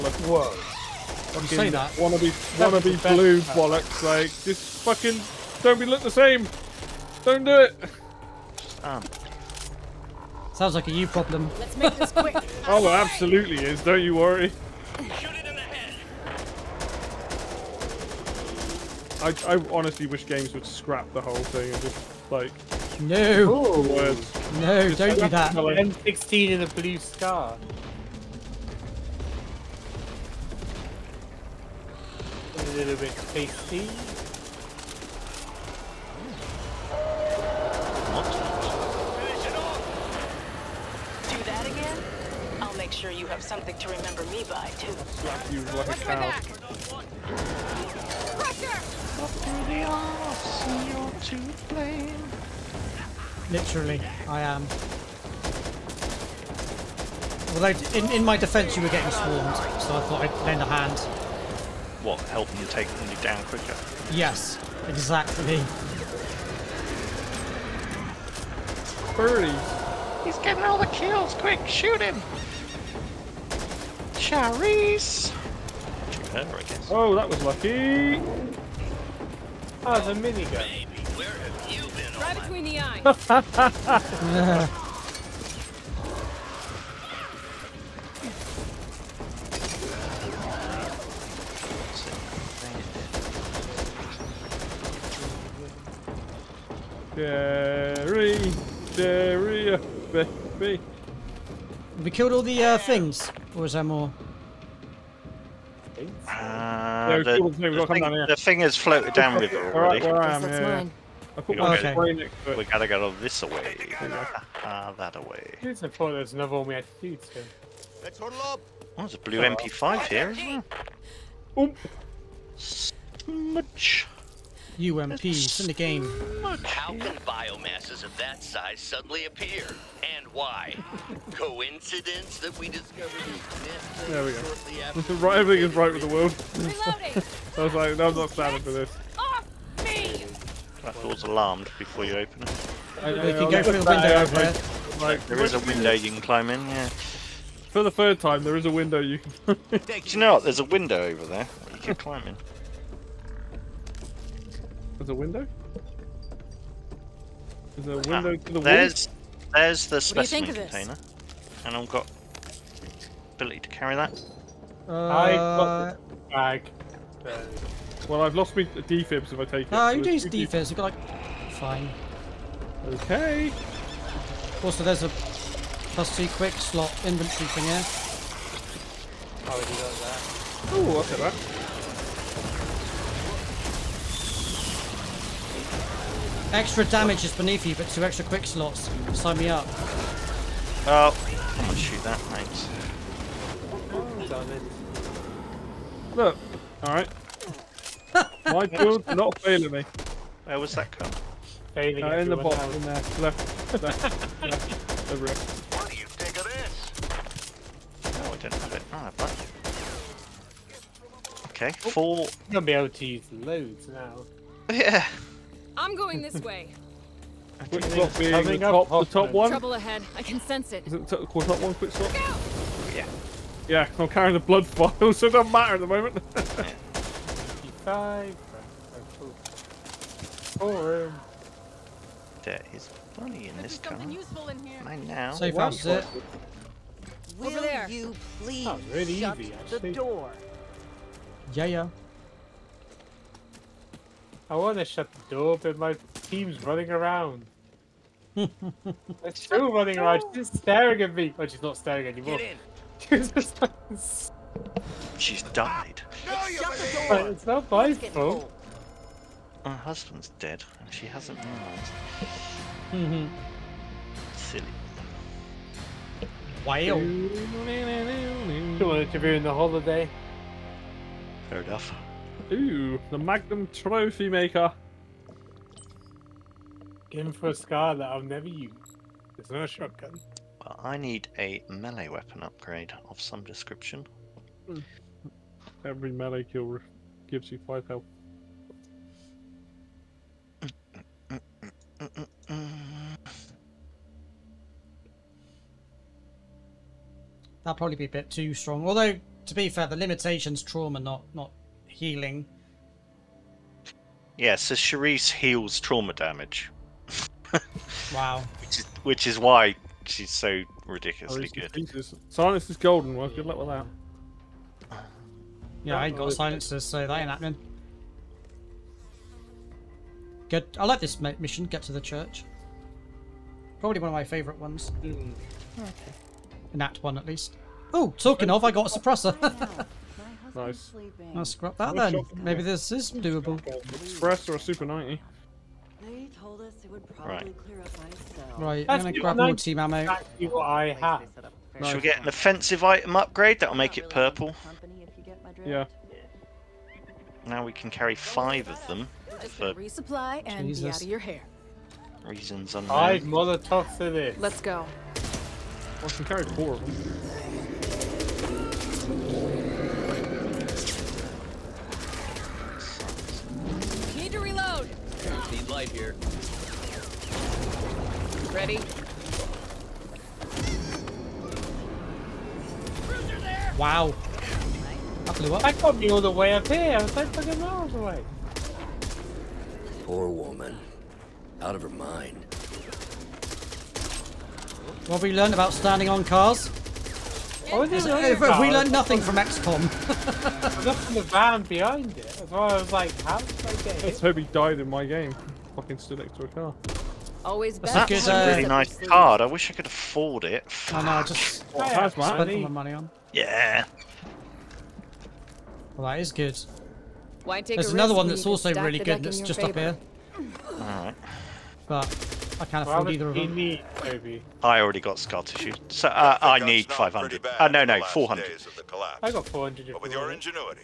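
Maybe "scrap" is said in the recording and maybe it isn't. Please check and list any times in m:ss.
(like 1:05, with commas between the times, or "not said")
0:20, 5:31.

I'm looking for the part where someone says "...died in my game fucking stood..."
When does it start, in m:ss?
6:34.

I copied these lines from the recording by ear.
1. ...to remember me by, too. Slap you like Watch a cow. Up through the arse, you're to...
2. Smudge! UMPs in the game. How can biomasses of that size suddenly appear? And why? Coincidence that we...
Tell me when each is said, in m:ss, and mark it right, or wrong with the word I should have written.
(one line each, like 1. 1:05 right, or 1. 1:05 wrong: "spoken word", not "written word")
1. 0:43 right
2. 2:02 right.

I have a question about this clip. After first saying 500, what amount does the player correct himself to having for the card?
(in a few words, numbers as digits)
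400.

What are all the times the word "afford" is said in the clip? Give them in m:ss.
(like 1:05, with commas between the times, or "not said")
6:39, 6:52.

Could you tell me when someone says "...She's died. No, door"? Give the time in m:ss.
4:15.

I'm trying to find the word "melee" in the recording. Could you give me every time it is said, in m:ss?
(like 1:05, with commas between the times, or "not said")
4:41, 4:46.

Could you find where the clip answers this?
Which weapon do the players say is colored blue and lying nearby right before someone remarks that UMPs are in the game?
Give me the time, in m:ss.
1:59.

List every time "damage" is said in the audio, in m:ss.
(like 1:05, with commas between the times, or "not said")
3:06, 5:06.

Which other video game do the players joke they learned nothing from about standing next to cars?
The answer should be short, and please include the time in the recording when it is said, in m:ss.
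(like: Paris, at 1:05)
XCOM, at 6:29.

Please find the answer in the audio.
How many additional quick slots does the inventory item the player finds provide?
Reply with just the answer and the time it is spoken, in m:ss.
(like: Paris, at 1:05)
plus two, at 2:55.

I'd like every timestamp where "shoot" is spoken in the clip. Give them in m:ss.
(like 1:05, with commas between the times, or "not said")
1:11, 3:11.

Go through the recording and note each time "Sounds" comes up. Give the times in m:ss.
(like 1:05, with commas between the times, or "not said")
0:10.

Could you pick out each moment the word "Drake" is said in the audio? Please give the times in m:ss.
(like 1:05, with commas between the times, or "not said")
not said.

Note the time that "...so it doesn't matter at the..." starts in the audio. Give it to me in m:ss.
3:45.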